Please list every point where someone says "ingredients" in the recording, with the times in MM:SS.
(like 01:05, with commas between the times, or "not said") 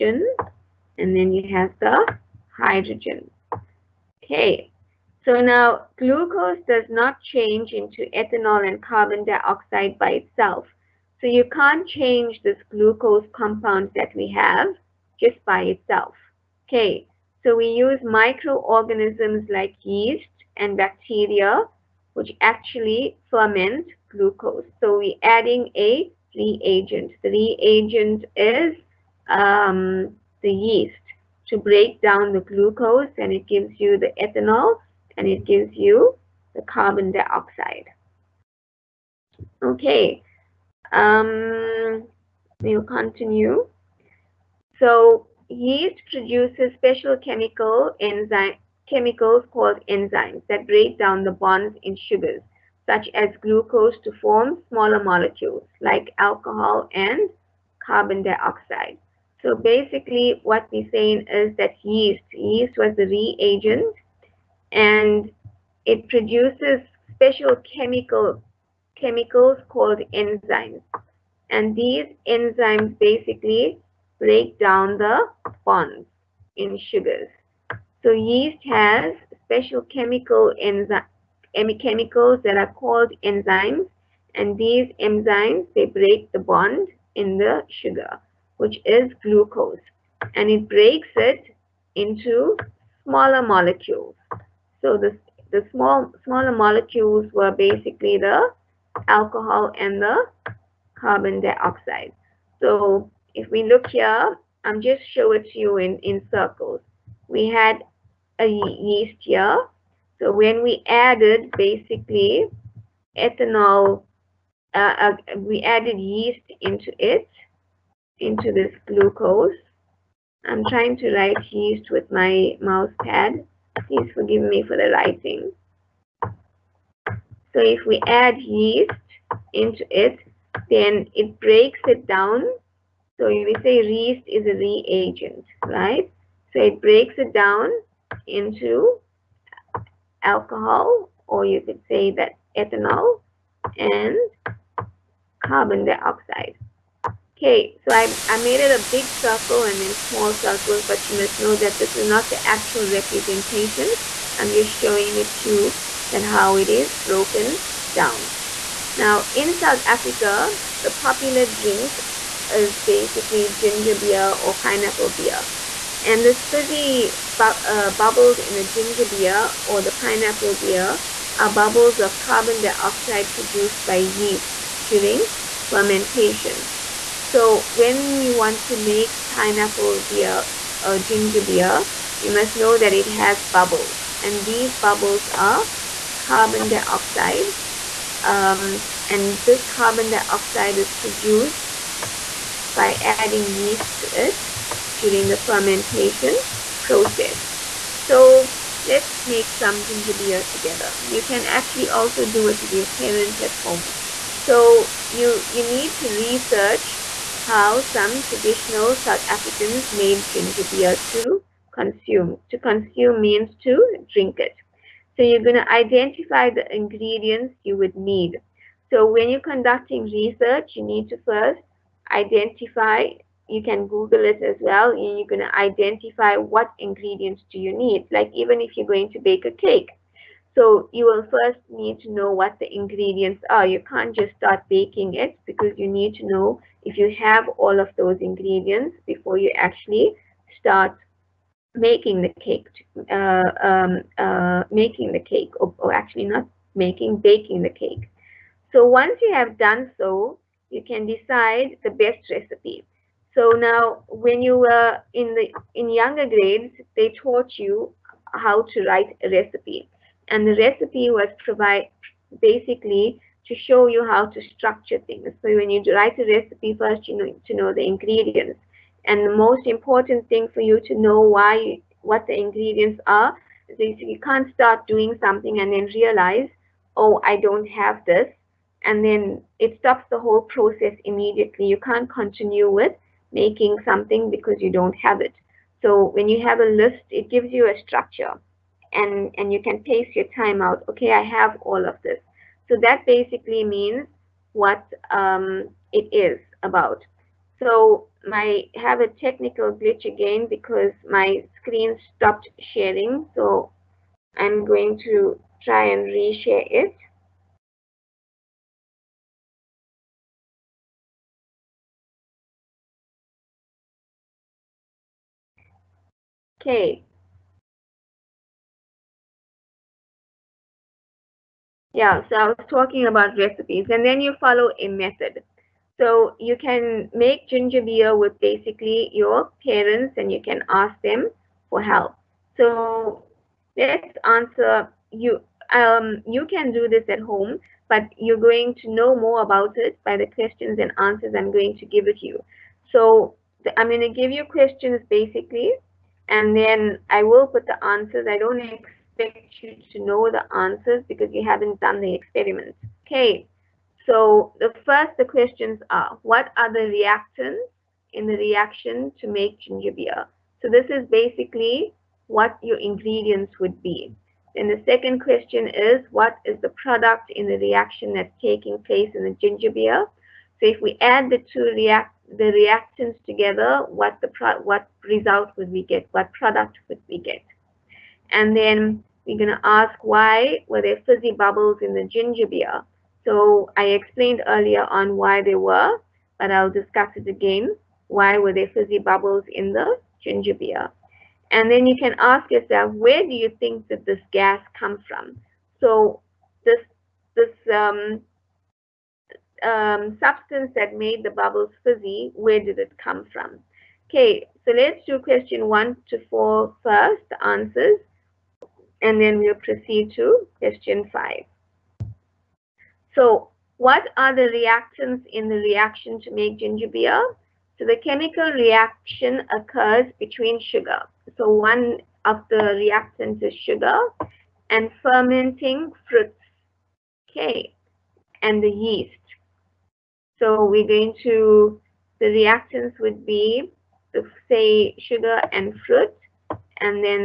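03:36, 03:46, 03:52, 03:58, 04:27, 04:32, 06:02.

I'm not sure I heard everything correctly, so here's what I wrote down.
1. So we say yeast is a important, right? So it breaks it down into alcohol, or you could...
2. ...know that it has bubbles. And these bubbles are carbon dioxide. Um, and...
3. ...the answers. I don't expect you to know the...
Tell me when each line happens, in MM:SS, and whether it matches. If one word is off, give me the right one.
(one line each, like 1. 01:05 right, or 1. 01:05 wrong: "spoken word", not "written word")
1. 02:13 wrong: "reagent", not "important"
2. 03:02 right
3. 05:47 right.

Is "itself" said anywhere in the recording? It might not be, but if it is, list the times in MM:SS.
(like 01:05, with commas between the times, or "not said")
00:10, 00:15.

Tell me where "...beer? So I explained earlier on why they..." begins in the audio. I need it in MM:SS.
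06:22.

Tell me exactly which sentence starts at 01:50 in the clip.
So when we added basically ethanol, uh, uh, we added yeast into it, into this glucose.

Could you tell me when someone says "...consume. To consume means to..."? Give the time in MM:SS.
03:31.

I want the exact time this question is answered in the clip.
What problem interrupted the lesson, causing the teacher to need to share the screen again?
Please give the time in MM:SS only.
04:59.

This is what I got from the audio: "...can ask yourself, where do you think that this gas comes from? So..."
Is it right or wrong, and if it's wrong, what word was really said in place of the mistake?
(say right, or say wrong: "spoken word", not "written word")
right.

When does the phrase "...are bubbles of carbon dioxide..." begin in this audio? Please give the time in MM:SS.
02:51.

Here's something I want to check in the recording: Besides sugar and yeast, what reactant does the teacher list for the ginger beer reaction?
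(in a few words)
Fermenting fruits.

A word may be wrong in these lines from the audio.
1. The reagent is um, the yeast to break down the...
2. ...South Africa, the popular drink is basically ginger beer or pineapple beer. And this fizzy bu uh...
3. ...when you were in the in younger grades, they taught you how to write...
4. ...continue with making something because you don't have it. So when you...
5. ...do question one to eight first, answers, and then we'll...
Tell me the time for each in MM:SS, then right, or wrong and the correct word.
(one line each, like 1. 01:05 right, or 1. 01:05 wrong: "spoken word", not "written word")
1. 00:27 right
2. 02:39 right
3. 04:14 right
4. 04:42 right
5. 06:45 wrong: "four", not "eight".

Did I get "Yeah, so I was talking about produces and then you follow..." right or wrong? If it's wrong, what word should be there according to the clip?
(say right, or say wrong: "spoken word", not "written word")
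wrong: "recipes", not "produces".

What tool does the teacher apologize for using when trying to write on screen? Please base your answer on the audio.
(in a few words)
Mouse pad.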